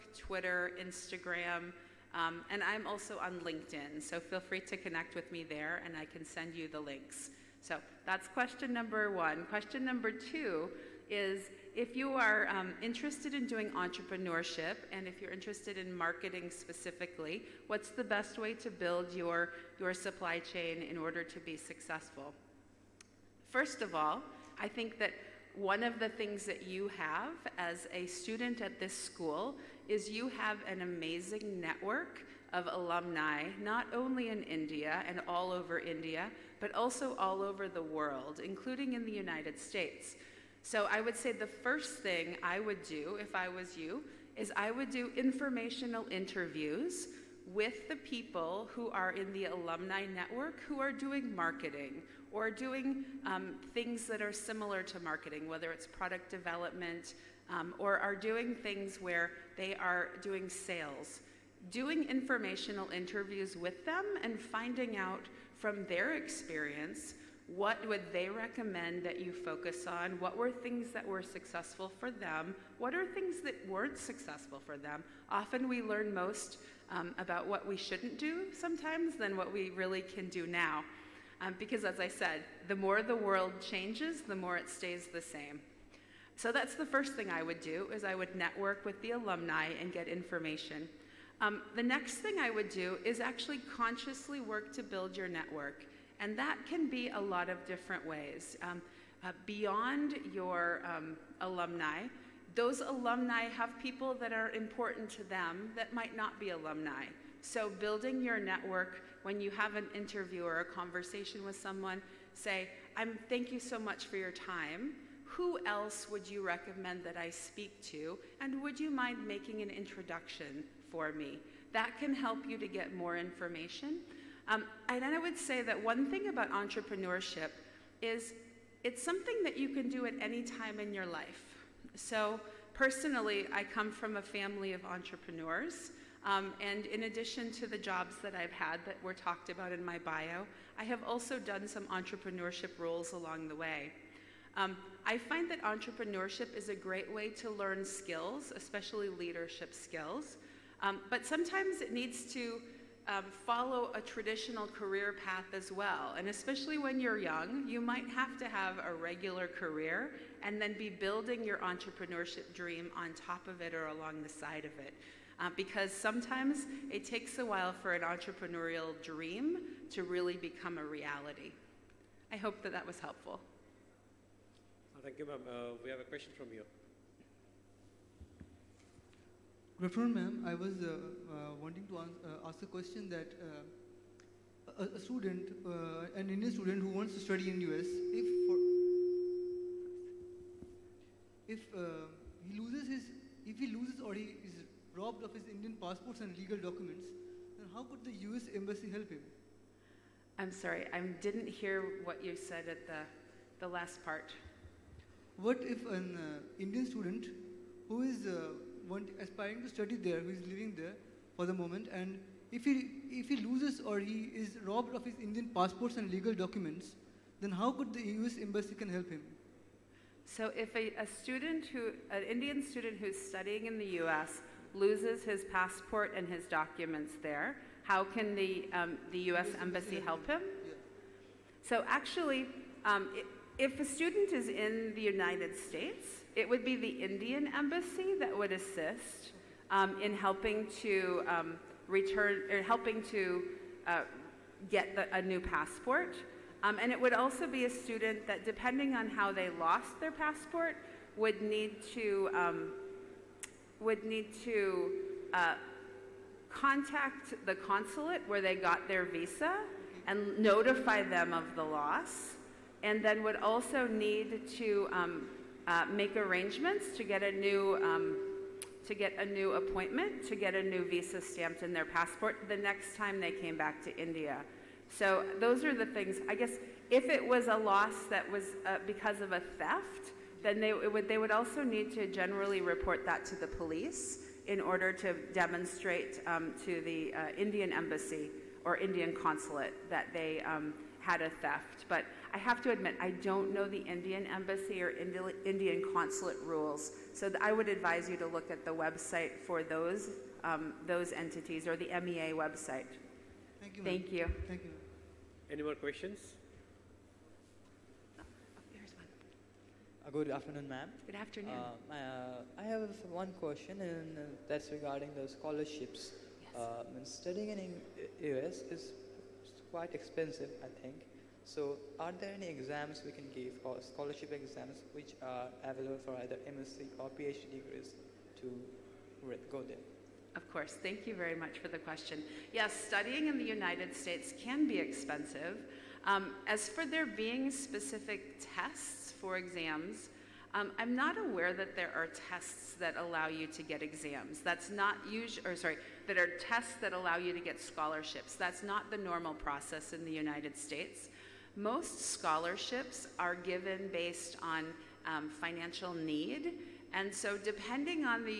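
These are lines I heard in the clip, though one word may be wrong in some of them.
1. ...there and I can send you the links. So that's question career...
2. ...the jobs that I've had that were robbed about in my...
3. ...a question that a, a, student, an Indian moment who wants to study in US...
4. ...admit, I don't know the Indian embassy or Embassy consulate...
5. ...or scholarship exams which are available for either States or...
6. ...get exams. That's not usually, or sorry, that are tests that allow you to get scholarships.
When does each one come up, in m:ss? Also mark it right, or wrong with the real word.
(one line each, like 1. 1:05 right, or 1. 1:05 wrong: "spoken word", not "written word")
1. 0:05 wrong: "number", not "career"
2. 2:17 wrong: "talked", not "robbed"
3. 3:02 wrong: "student", not "moment"
4. 4:52 wrong: "Indian", not "Embassy"
5. 5:23 wrong: "MSc", not "States"
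6. 5:43 right.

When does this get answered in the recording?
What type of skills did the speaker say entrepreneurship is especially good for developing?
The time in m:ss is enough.
2:29.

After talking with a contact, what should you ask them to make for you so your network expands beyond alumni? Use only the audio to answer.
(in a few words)
an introduction.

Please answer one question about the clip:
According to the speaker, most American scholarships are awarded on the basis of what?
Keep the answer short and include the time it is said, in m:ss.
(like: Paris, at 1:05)
financial need, at 5:55.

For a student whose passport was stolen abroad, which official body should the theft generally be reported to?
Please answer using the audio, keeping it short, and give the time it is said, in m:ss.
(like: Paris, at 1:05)
the police, at 4:43.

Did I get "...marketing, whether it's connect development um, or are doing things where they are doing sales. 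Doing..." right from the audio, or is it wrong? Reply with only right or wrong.
wrong.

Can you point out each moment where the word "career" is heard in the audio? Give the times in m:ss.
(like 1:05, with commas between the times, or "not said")
2:34, 2:39.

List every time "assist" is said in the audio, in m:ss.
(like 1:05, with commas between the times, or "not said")
3:58.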